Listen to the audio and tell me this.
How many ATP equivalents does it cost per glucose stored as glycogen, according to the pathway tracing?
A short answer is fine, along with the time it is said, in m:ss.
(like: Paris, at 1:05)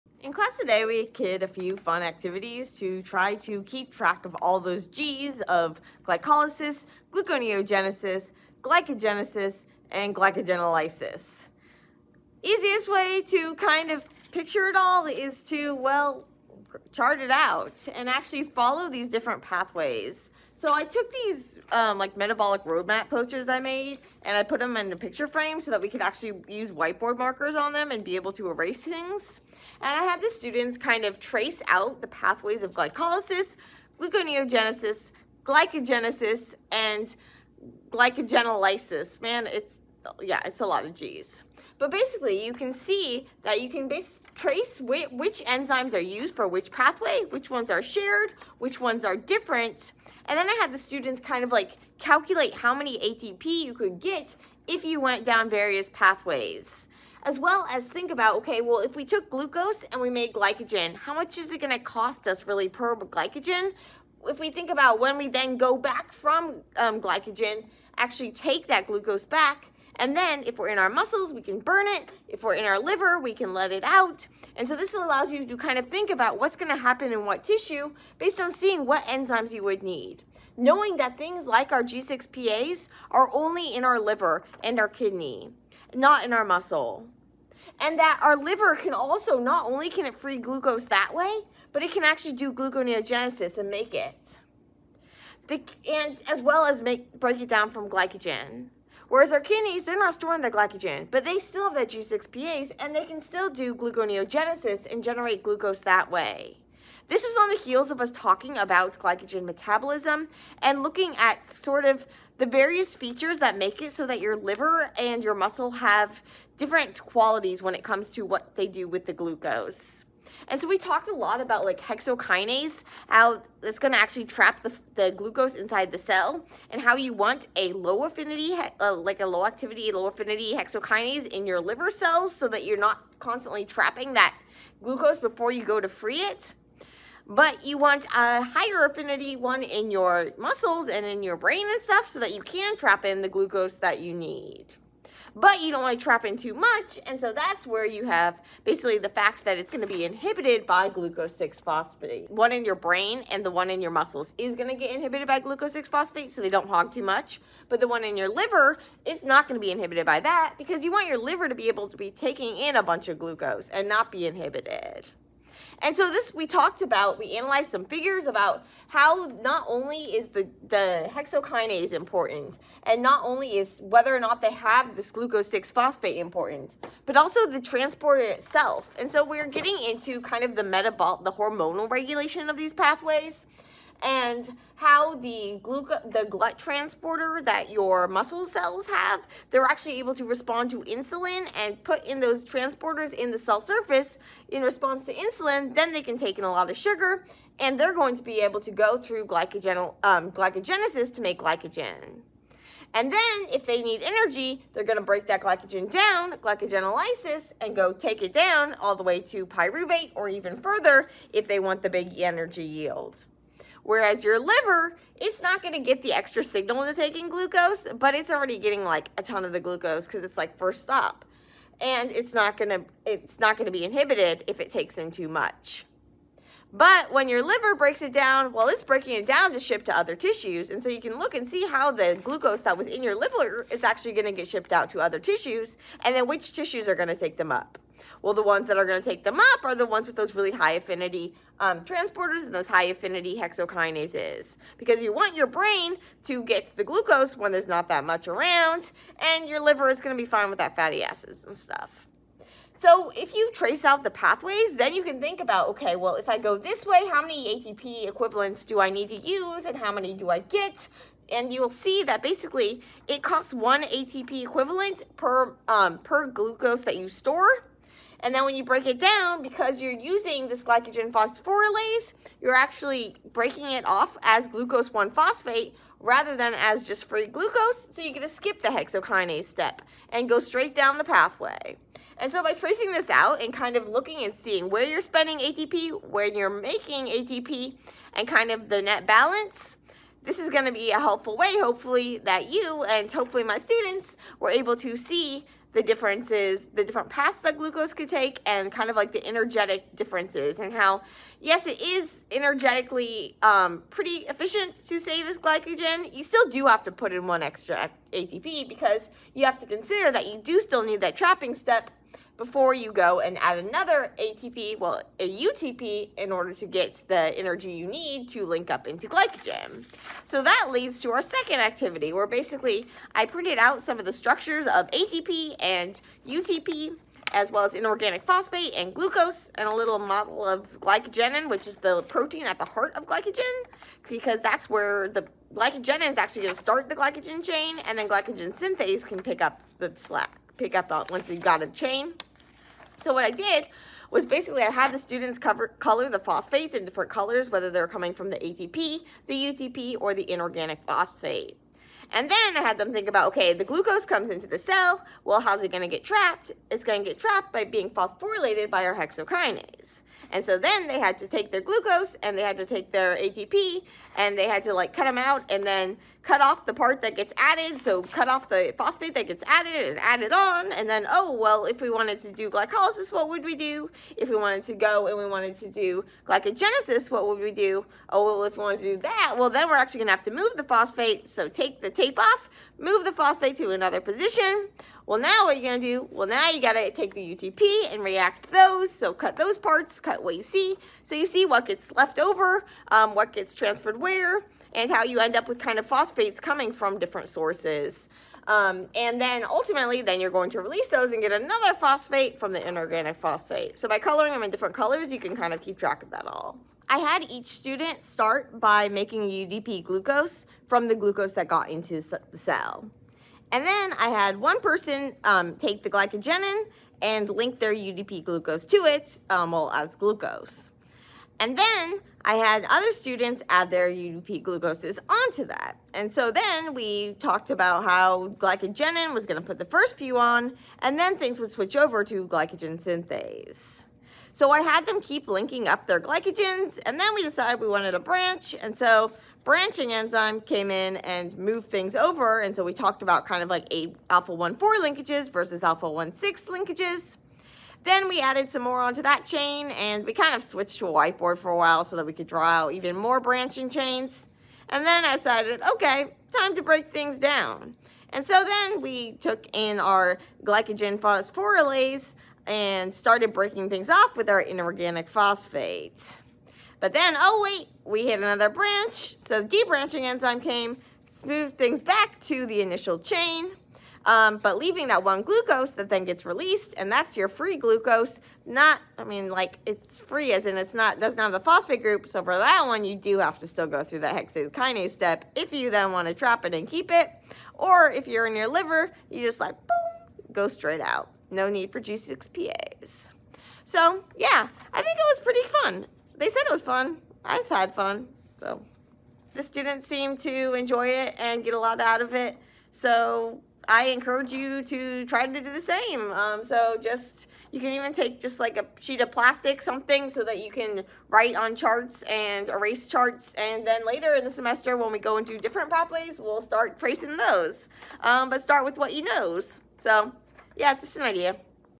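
1, at 4:23.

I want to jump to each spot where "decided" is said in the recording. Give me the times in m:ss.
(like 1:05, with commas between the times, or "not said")
7:17, 7:35.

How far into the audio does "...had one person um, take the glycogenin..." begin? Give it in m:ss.
6:54.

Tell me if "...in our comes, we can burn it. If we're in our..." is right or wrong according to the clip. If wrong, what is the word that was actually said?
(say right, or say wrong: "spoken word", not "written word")
wrong: "muscles", not "comes".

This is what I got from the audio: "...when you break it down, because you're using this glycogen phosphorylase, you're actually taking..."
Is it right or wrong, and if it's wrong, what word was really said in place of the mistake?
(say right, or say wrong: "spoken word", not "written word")
wrong: "breaking", not "taking".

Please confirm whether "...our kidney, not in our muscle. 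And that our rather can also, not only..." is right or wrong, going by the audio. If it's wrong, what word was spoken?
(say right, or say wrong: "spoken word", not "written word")
wrong: "liver", not "rather".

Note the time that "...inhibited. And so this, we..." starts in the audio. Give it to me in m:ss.
2:44.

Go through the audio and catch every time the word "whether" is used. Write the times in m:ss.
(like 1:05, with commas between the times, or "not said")
2:53, 5:47.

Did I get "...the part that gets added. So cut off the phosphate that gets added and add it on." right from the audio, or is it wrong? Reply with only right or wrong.
right.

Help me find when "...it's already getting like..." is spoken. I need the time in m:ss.
3:38.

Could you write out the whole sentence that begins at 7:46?
But then, oh wait, we hit another branch.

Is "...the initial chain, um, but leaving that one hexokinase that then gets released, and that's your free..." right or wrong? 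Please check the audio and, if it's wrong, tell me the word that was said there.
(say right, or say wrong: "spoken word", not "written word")
wrong: "glucose", not "hexokinase".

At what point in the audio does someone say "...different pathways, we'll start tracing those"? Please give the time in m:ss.
8:35.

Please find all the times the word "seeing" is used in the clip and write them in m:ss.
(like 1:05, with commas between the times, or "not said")
1:18, 4:44.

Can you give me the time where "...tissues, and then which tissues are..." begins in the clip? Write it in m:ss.
3:55.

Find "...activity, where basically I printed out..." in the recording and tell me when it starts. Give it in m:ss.
5:21.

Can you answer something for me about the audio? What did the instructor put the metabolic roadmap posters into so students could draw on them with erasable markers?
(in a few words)
picture frame.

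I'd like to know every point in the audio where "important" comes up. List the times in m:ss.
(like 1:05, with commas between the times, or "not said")
2:51, 2:56.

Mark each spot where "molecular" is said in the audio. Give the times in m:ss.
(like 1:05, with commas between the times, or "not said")
not said.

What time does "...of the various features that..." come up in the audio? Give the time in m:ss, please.
1:51.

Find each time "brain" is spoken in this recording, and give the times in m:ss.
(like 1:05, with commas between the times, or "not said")
2:21, 2:32, 4:05.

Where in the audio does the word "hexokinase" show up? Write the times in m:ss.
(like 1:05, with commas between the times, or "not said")
2:01, 2:10, 2:51, 4:03, 4:38, 5:58.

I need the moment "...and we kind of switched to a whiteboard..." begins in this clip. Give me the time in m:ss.
7:29.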